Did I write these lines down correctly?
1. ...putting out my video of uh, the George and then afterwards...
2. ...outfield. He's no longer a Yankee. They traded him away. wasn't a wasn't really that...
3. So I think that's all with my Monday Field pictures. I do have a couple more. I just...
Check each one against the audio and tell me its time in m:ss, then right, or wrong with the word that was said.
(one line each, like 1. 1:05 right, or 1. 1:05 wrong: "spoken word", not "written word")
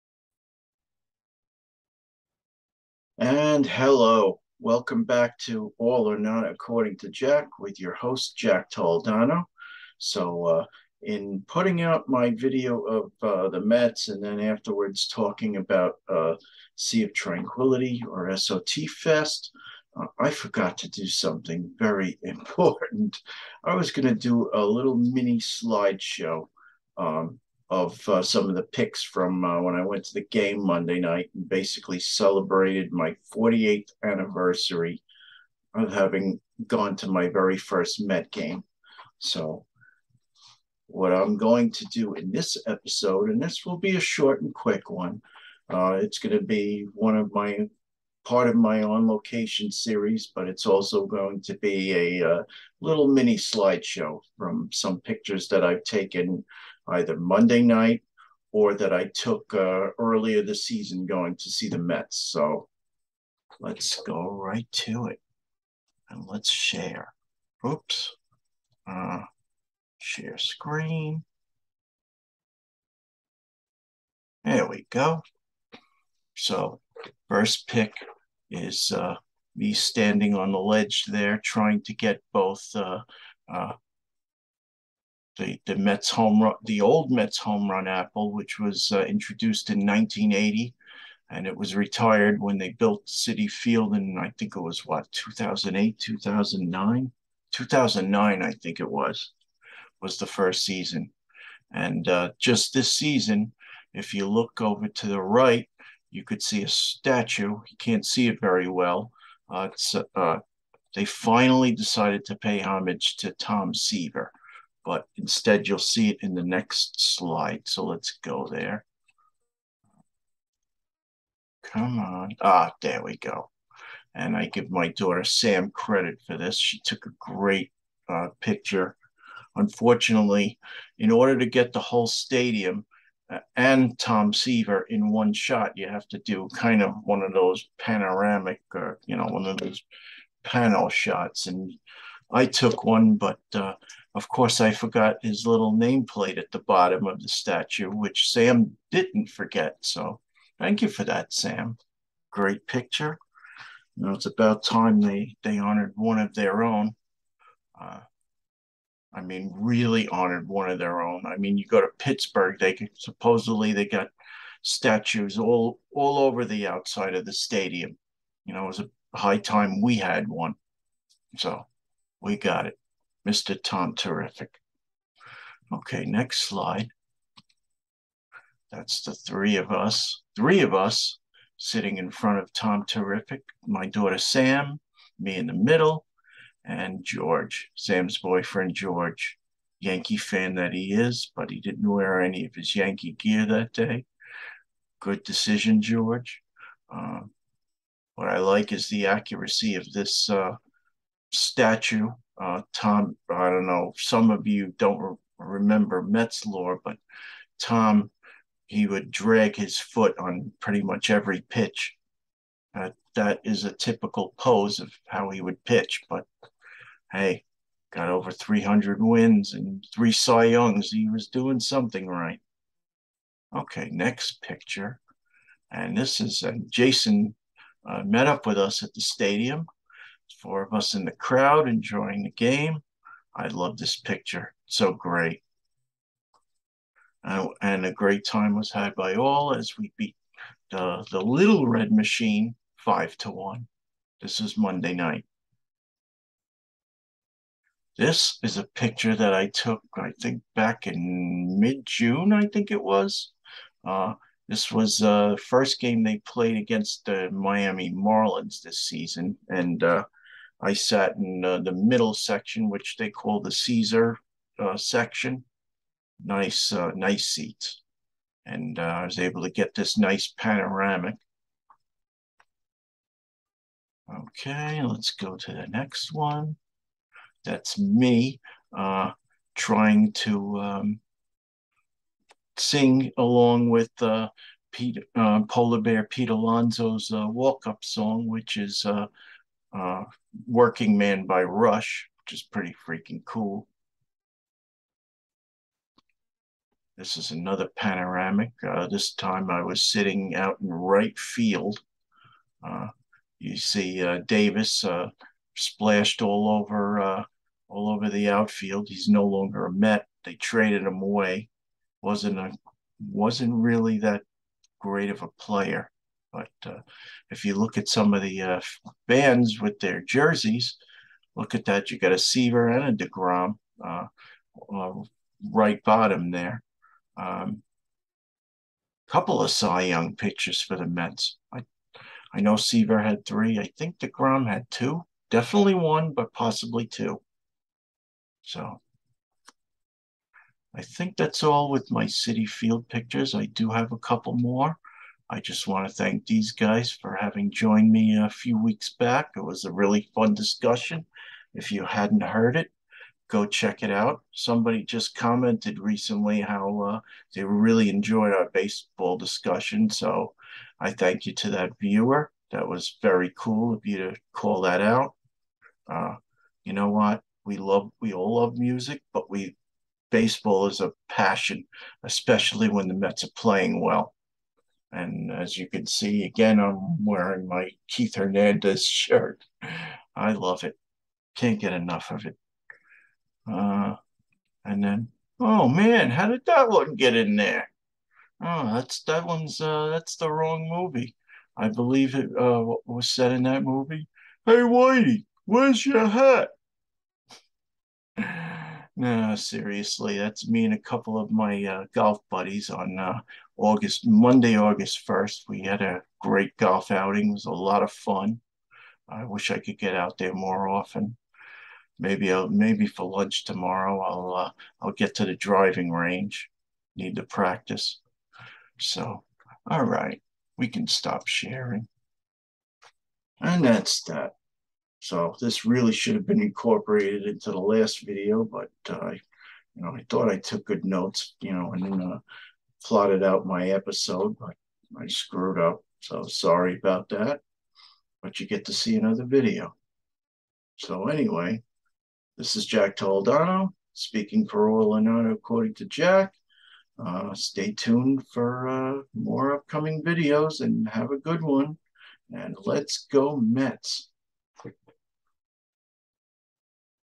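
1. 0:11 wrong: "Mets", not "George"
2. 5:08 wrong: "Met", not "Yankee"
3. 5:38 wrong: "Citi", not "Monday".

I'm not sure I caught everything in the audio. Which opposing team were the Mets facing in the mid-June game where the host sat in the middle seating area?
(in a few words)
Miami Marlins.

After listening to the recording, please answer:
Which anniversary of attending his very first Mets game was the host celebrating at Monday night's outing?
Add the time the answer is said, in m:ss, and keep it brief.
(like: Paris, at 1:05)
48th, at 0:33.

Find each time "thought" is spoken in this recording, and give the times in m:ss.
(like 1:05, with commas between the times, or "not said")
7:10.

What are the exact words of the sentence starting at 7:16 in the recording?
So sorry about that, but you get to see another video.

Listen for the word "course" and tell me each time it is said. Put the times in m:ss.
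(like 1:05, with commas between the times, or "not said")
2:24.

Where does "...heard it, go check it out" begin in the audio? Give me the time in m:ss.
5:52.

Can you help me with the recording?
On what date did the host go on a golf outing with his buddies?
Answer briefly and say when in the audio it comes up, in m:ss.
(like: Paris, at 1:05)
August 1, at 6:44.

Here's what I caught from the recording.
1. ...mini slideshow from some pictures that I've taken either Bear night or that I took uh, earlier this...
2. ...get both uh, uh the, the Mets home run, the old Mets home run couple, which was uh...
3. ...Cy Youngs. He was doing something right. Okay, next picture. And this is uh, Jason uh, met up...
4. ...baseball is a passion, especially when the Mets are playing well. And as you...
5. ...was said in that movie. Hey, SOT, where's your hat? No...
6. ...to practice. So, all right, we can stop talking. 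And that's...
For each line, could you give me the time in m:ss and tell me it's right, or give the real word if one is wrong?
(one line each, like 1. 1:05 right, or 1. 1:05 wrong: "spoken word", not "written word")
1. 0:53 wrong: "Monday", not "Bear"
2. 1:21 wrong: "apple", not "couple"
3. 3:40 right
4. 6:10 right
5. 6:32 wrong: "Whitey", not "SOT"
6. 6:57 wrong: "sharing", not "talking".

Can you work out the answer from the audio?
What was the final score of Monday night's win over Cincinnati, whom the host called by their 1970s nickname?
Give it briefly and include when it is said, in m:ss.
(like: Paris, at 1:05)
5 to 1, at 4:02.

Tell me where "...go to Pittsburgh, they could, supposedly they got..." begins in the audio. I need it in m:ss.
2:41.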